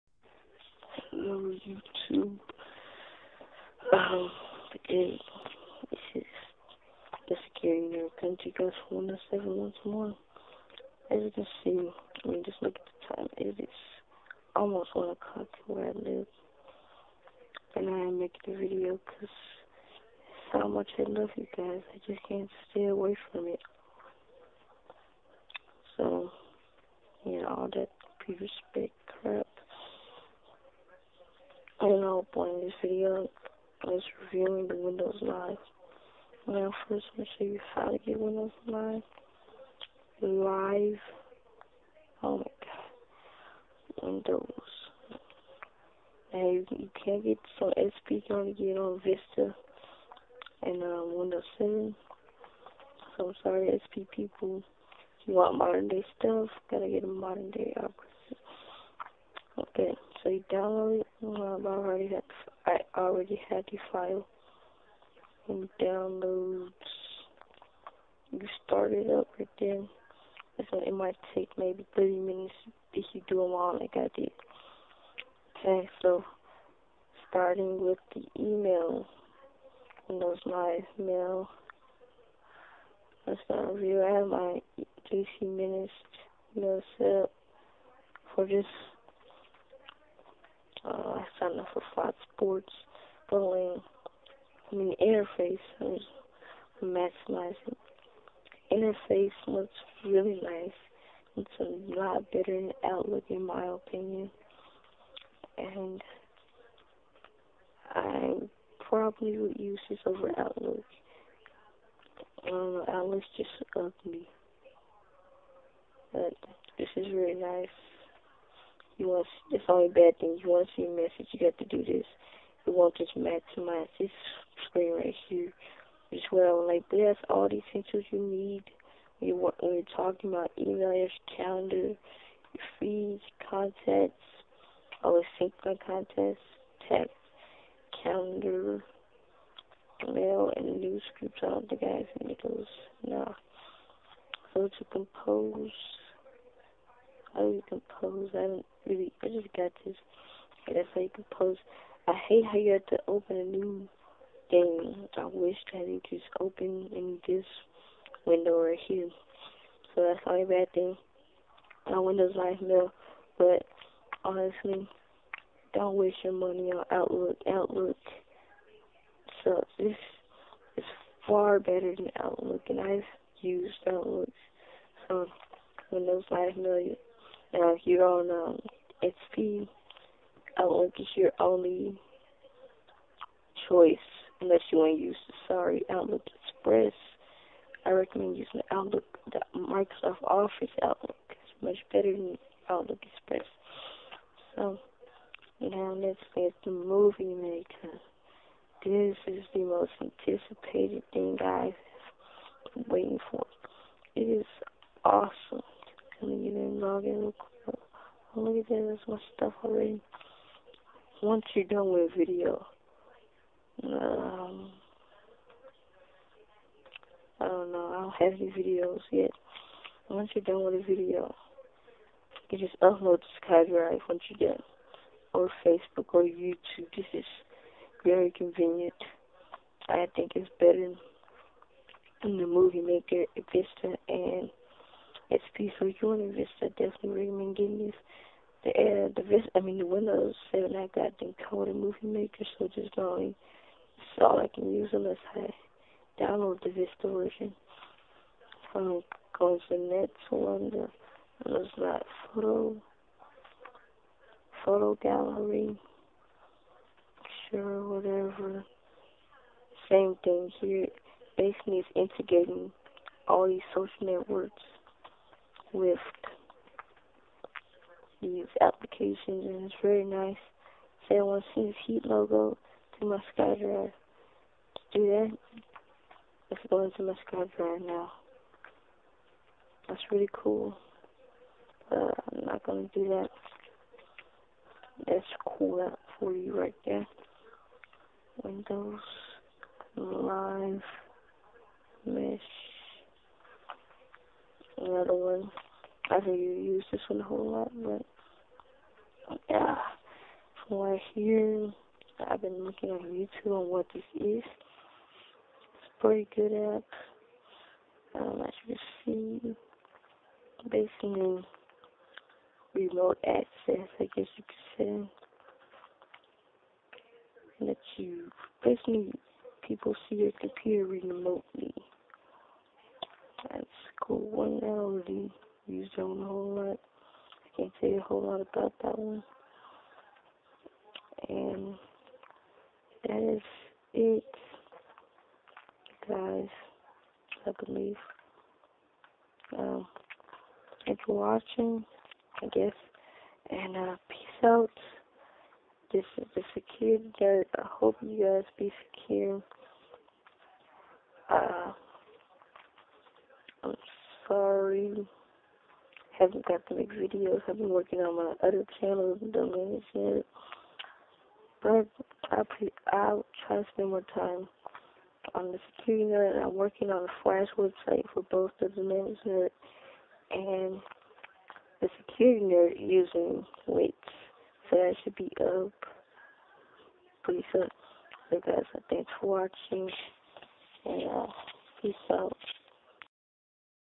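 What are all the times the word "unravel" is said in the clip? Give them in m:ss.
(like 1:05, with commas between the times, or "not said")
not said.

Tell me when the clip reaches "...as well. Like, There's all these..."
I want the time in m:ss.
2:06.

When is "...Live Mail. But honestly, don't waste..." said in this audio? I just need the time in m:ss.
2:42.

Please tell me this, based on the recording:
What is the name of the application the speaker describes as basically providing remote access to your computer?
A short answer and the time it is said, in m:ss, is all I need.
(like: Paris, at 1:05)
Windows Live Mesh, at 4:48.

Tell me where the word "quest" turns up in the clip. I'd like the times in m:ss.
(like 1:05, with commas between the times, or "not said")
not said.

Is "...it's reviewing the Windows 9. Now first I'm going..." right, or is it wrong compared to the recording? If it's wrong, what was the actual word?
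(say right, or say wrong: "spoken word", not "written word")
right.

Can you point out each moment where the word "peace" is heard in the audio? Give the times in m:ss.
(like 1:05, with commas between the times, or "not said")
5:44, 6:21.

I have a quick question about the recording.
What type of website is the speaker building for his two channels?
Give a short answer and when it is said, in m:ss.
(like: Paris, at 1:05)
flash website, at 6:07.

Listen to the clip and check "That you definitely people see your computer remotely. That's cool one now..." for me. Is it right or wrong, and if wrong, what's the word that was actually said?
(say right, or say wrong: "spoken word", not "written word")
wrong: "basically", not "definitely".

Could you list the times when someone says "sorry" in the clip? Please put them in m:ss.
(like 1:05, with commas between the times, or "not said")
0:53, 3:05, 5:54.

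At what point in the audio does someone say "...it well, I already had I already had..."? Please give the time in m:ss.
1:01.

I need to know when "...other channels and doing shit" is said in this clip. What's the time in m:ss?
5:58.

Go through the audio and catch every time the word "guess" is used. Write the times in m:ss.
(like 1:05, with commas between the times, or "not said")
5:14, 5:42.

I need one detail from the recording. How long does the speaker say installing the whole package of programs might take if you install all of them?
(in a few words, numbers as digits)
30 minutes.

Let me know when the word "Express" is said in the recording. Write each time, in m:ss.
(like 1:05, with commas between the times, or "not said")
3:06, 3:13.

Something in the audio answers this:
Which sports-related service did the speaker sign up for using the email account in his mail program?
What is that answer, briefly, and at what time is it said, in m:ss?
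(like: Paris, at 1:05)
Fox Sports, at 1:31.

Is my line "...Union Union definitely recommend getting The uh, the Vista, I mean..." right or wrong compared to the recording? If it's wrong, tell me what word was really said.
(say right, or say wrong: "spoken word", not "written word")
wrong: "Vista", not "Union".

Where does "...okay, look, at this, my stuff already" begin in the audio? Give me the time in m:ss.
3:26.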